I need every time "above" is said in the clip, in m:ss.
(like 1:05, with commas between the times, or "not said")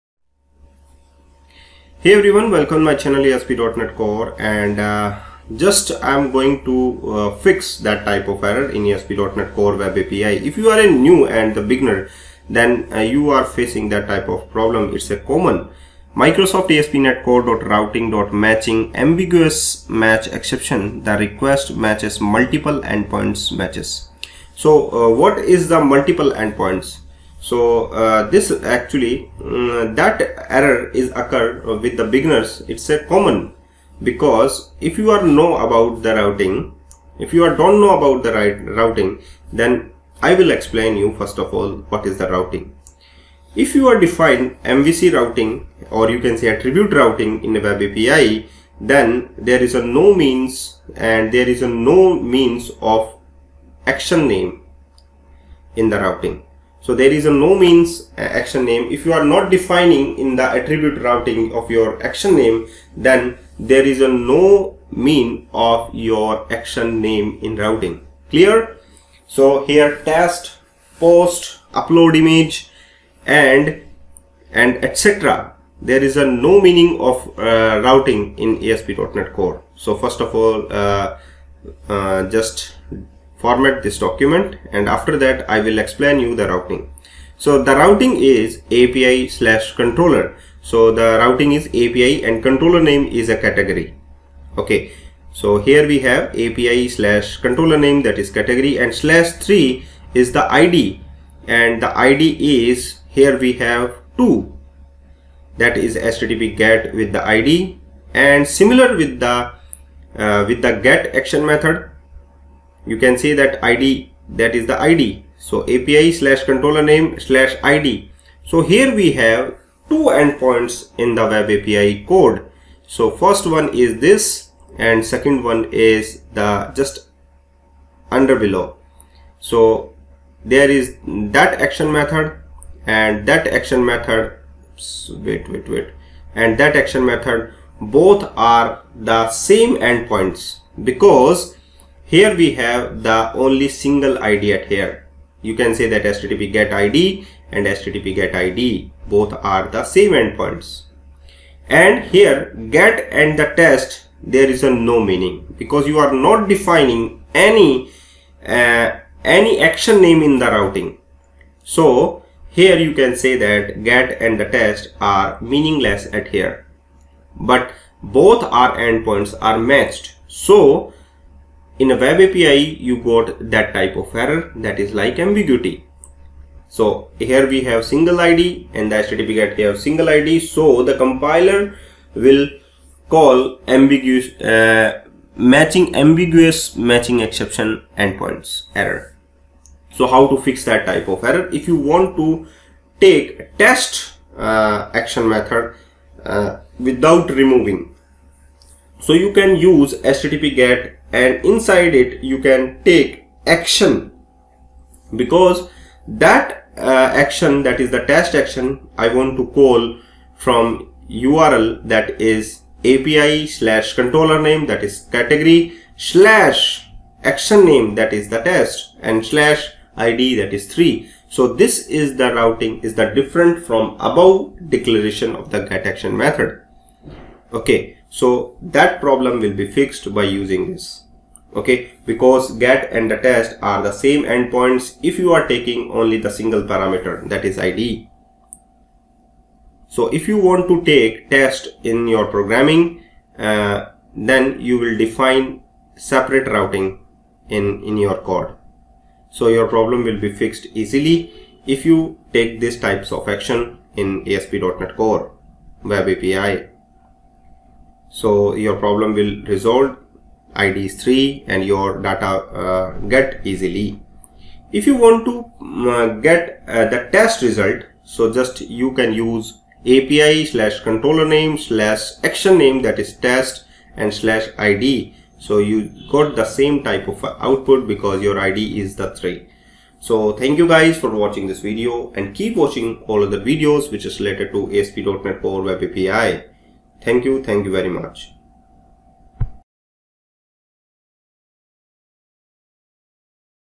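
3:43.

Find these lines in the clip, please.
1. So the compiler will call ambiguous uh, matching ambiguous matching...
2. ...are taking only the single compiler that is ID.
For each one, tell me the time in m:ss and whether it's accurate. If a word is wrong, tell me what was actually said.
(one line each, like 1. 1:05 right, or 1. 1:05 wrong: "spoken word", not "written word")
1. 3:00 right
2. 3:55 wrong: "parameter", not "compiler".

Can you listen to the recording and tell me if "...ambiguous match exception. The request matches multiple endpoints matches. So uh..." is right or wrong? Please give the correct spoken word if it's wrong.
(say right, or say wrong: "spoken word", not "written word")
right.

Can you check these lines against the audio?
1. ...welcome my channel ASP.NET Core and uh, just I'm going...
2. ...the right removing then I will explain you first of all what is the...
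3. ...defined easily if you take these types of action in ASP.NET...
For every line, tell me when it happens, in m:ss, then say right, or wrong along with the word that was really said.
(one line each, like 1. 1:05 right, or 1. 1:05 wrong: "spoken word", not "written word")
1. 0:02 right
2. 0:38 wrong: "routing", not "removing"
3. 4:10 wrong: "fixed", not "defined".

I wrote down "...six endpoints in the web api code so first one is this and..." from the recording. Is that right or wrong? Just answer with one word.
wrong.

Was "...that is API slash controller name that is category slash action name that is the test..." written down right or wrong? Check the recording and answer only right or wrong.
right.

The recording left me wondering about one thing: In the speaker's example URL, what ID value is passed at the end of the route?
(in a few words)
3.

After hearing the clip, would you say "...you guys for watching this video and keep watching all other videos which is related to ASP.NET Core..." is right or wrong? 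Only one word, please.
right.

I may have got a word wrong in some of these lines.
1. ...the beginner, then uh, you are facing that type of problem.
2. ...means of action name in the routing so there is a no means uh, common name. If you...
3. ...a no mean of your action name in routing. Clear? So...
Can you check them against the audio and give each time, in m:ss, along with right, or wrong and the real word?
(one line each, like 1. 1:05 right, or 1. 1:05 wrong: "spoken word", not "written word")
1. 0:11 right
2. 0:52 wrong: "action", not "common"
3. 1:04 right.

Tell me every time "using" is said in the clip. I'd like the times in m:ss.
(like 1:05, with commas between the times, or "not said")
3:50.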